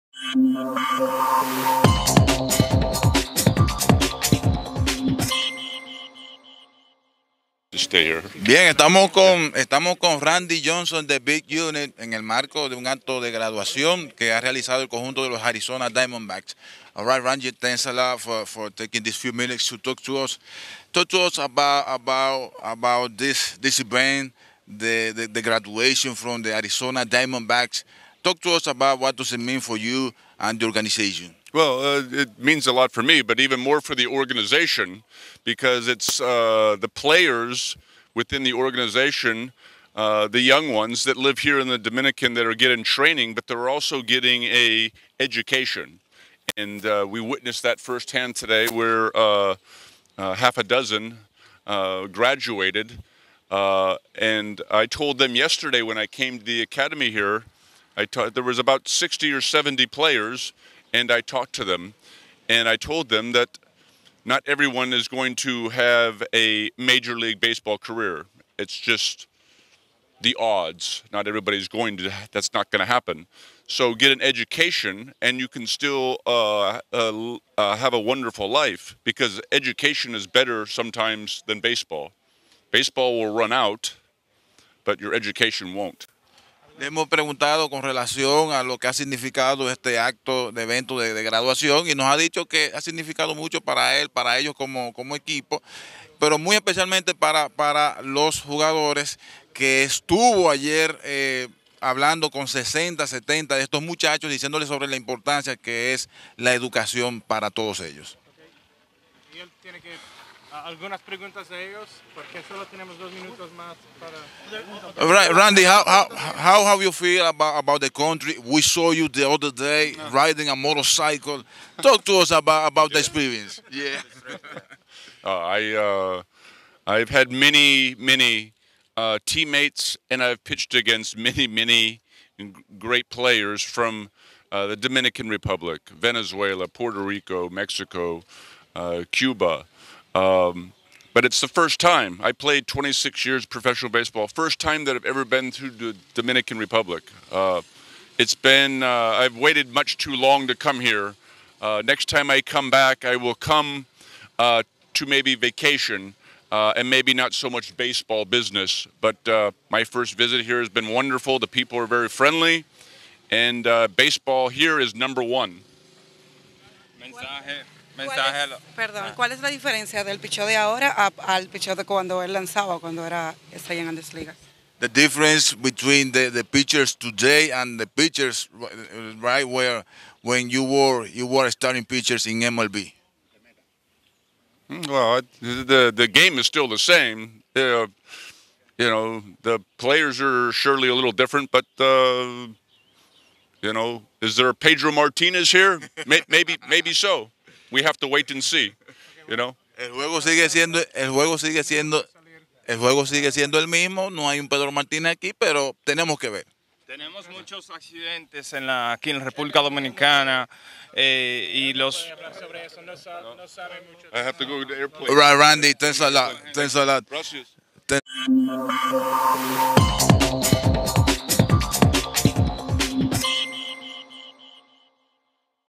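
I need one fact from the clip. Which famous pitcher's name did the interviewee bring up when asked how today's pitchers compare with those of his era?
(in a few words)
Pedro Martinez.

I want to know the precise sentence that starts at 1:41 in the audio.
Eh, hablando con 60, 70 de estos muchachos, diciéndoles sobre la importancia que es la educación para todos ellos.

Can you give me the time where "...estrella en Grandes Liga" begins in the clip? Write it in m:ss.
2:53.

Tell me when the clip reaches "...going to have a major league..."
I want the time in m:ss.
1:05.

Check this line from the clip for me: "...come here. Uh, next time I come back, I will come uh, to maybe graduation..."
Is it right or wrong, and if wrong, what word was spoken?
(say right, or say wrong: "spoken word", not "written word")
wrong: "vacation", not "graduation".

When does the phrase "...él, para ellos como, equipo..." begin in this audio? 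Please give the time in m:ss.
1:33.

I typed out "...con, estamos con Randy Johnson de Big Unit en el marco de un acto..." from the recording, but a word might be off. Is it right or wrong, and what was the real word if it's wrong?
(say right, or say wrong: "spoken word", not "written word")
right.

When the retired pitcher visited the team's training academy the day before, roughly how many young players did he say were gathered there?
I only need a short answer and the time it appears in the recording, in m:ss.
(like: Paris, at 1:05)
60 or 70, at 0:58.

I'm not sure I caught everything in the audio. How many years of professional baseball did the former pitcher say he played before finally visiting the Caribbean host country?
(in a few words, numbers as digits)
26.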